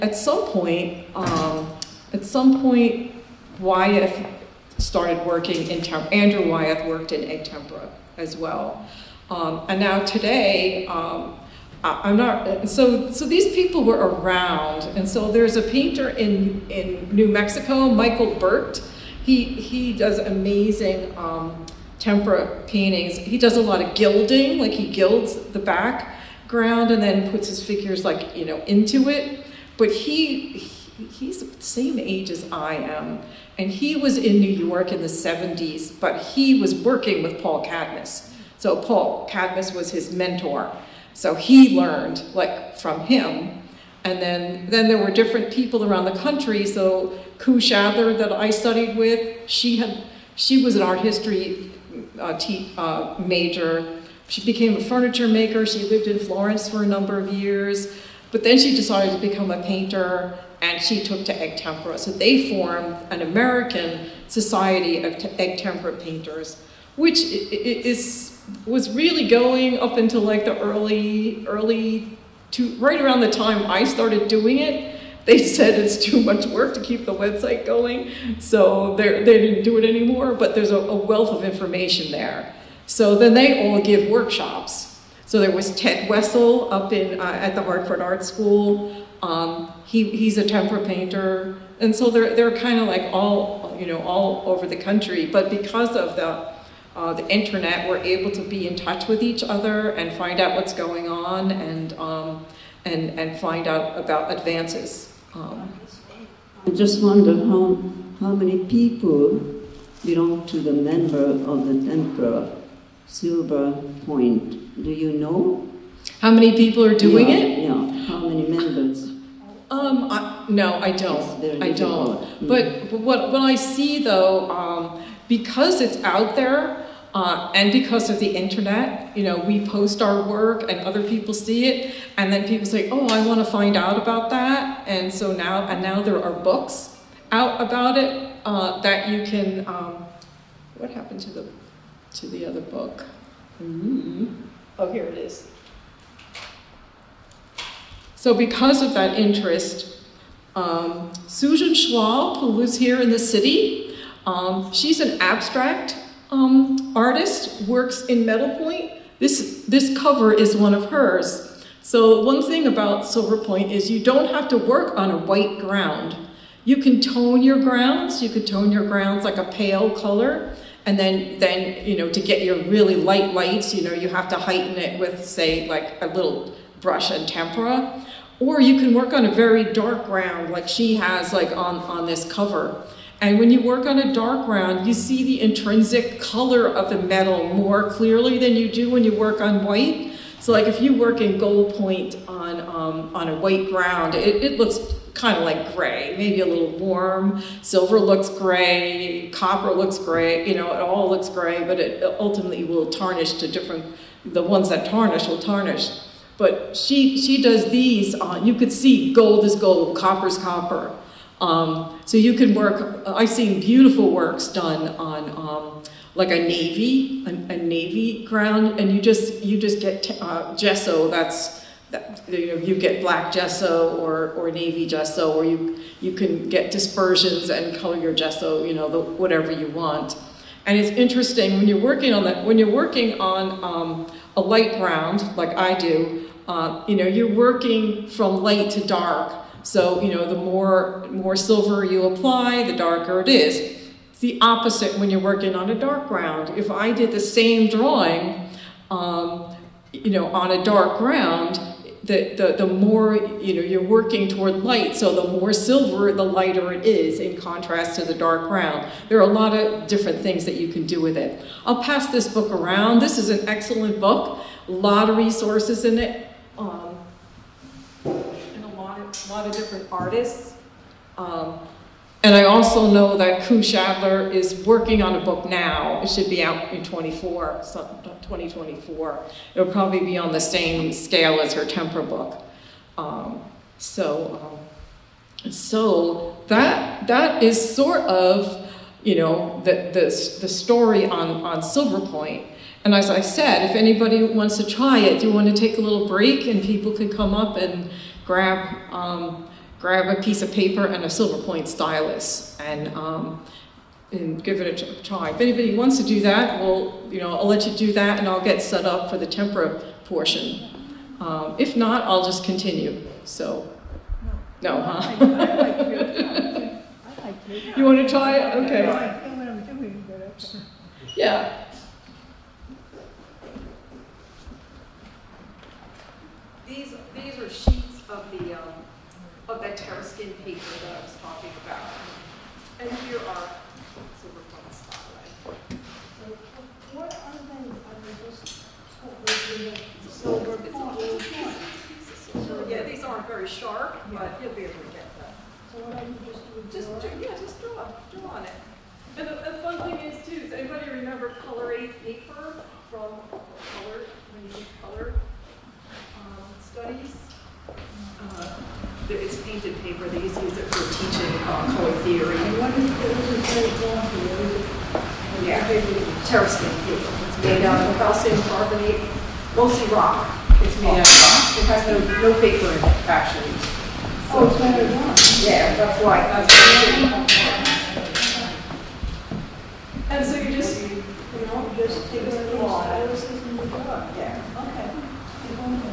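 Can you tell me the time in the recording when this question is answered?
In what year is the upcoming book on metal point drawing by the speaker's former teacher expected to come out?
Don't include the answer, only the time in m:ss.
4:37.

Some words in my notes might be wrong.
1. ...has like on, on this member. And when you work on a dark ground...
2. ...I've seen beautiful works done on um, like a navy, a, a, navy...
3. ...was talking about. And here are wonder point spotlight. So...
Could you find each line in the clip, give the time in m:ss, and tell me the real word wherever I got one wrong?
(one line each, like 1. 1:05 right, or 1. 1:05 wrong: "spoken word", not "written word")
1. 3:00 wrong: "cover", not "member"
2. 3:33 right
3. 5:31 wrong: "silver", not "wonder".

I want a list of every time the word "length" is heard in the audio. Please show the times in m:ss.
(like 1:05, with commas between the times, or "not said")
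not said.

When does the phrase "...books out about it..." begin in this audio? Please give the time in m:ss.
2:16.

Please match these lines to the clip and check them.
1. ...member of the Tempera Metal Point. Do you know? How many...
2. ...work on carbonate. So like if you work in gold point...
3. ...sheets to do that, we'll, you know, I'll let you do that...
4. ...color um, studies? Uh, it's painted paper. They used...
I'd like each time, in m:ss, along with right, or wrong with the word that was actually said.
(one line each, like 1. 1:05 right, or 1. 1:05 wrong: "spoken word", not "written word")
1. 1:50 wrong: "Silver", not "Metal"
2. 3:09 wrong: "white", not "carbonate"
3. 5:05 wrong: "wants", not "sheets"
4. 5:54 right.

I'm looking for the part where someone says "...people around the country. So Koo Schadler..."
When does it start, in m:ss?
0:45.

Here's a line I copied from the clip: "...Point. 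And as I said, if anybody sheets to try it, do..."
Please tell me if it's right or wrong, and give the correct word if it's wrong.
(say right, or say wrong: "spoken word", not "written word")
wrong: "wants", not "sheets".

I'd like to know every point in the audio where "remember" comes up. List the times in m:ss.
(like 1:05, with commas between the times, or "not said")
5:50.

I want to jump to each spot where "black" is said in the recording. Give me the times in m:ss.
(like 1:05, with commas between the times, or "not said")
3:43.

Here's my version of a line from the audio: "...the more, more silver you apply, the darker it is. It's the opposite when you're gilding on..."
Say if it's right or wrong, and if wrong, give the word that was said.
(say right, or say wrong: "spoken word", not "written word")
wrong: "working", not "gilding".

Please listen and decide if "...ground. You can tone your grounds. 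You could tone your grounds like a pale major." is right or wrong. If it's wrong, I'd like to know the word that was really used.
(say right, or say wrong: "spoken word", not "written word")
wrong: "color", not "major".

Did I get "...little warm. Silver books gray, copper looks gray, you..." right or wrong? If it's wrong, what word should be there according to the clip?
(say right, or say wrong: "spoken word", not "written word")
wrong: "looks", not "books".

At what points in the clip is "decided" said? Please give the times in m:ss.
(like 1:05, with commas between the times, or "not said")
0:58.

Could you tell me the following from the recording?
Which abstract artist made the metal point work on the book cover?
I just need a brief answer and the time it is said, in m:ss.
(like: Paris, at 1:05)
Susan Schwalb, at 2:31.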